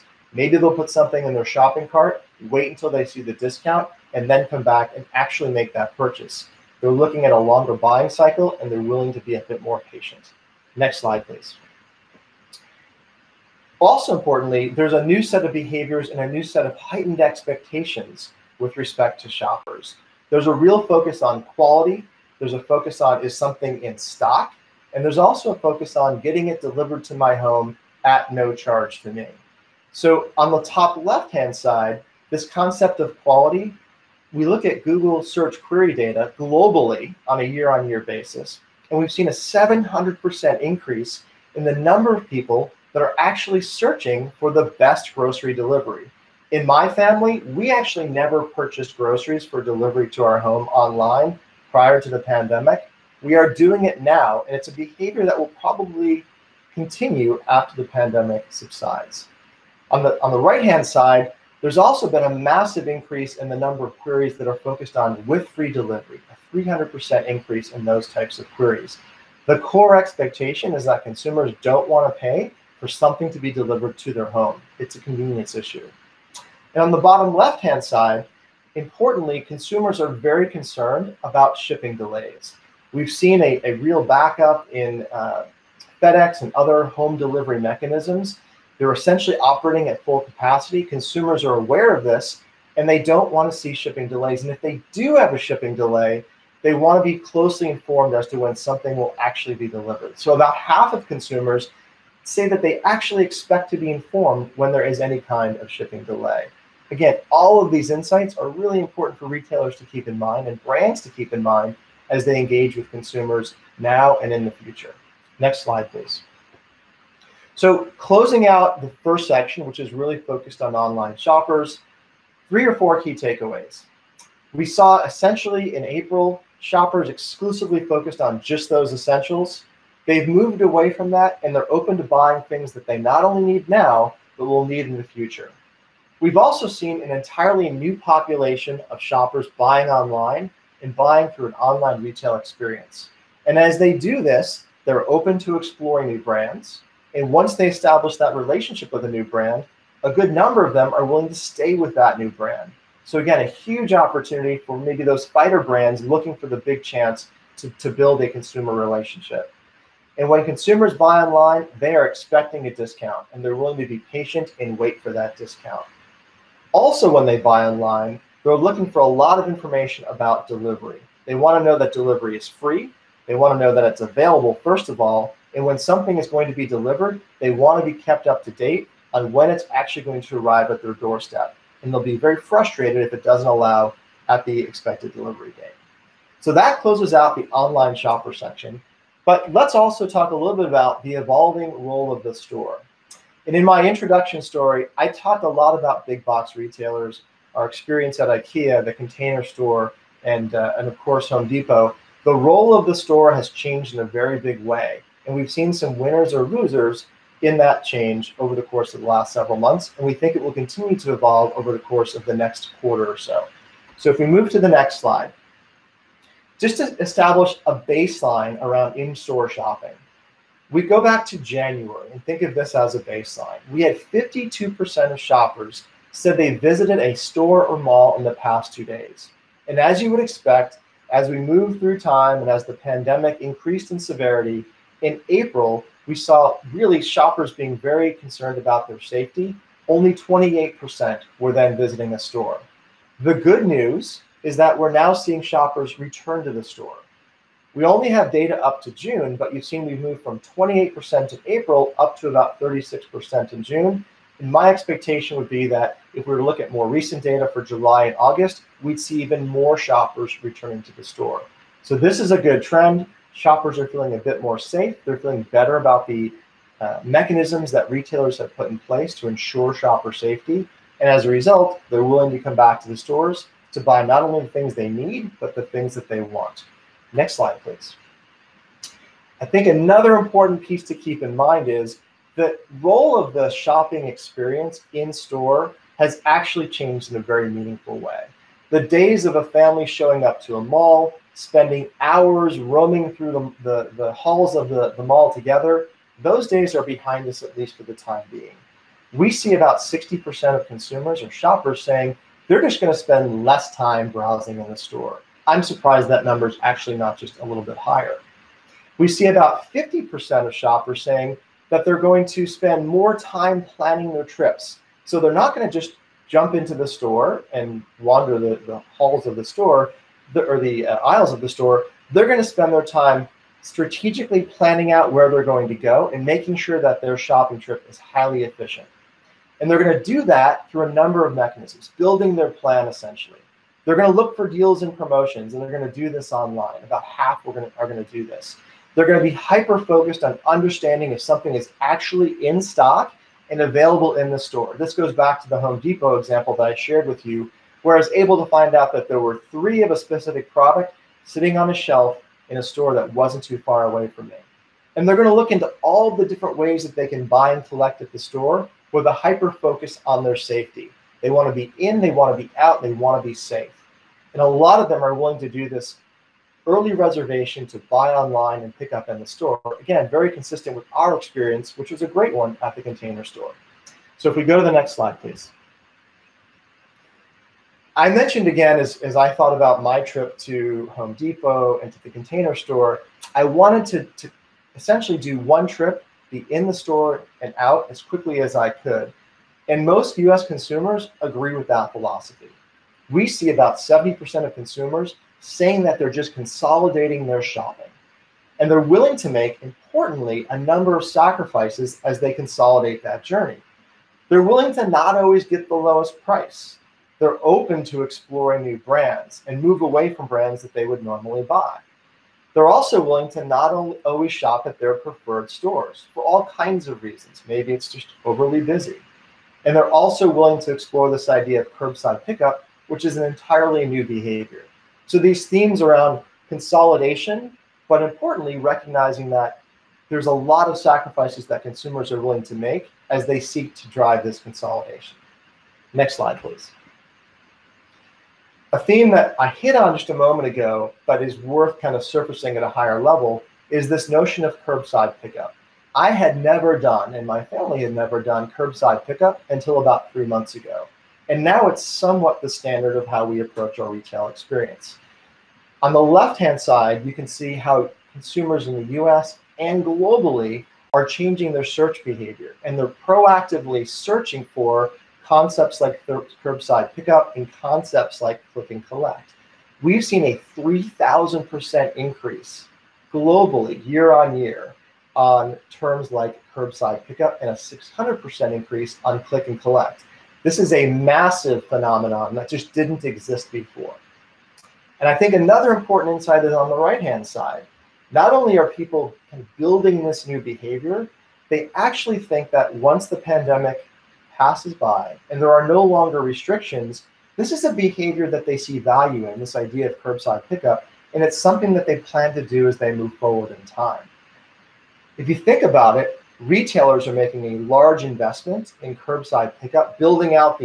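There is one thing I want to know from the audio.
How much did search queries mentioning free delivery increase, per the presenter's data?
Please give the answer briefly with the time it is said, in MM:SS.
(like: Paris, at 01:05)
300%, at 01:06.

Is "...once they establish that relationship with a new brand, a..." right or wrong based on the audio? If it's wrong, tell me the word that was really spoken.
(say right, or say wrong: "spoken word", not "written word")
right.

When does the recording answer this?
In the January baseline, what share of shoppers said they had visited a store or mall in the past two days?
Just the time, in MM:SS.
03:43.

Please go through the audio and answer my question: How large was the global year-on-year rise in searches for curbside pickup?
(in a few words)
3,000%.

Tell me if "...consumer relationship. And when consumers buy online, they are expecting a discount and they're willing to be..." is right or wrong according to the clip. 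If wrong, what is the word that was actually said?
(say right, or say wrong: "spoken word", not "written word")
right.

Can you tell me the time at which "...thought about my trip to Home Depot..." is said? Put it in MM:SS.
06:19.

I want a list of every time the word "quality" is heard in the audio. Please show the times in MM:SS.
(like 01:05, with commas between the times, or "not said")
00:21, 00:33.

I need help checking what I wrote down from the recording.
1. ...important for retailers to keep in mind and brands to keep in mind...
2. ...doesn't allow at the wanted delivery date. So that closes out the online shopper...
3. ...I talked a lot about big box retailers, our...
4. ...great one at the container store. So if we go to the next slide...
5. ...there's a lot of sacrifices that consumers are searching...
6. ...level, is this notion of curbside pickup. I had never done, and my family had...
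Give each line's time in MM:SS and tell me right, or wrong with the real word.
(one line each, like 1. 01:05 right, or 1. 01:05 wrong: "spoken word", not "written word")
1. 01:48 right
2. 03:03 wrong: "expected", not "wanted"
3. 03:14 right
4. 06:12 right
5. 07:10 wrong: "willing", not "searching"
6. 07:23 right.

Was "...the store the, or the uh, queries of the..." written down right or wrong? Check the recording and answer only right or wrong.
wrong.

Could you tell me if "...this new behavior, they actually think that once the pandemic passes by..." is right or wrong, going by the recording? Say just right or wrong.
right.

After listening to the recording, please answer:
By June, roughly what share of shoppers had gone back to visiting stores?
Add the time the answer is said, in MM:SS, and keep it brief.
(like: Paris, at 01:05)
36%, at 04:12.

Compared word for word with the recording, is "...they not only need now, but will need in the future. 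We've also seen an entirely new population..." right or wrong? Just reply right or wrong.
right.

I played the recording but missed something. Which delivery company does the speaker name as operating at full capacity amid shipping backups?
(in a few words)
FedEx.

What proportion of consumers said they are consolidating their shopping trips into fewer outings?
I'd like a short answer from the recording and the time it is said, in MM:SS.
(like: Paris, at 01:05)
70%, at 06:33.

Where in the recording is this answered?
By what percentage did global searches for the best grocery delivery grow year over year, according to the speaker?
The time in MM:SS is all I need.
00:39.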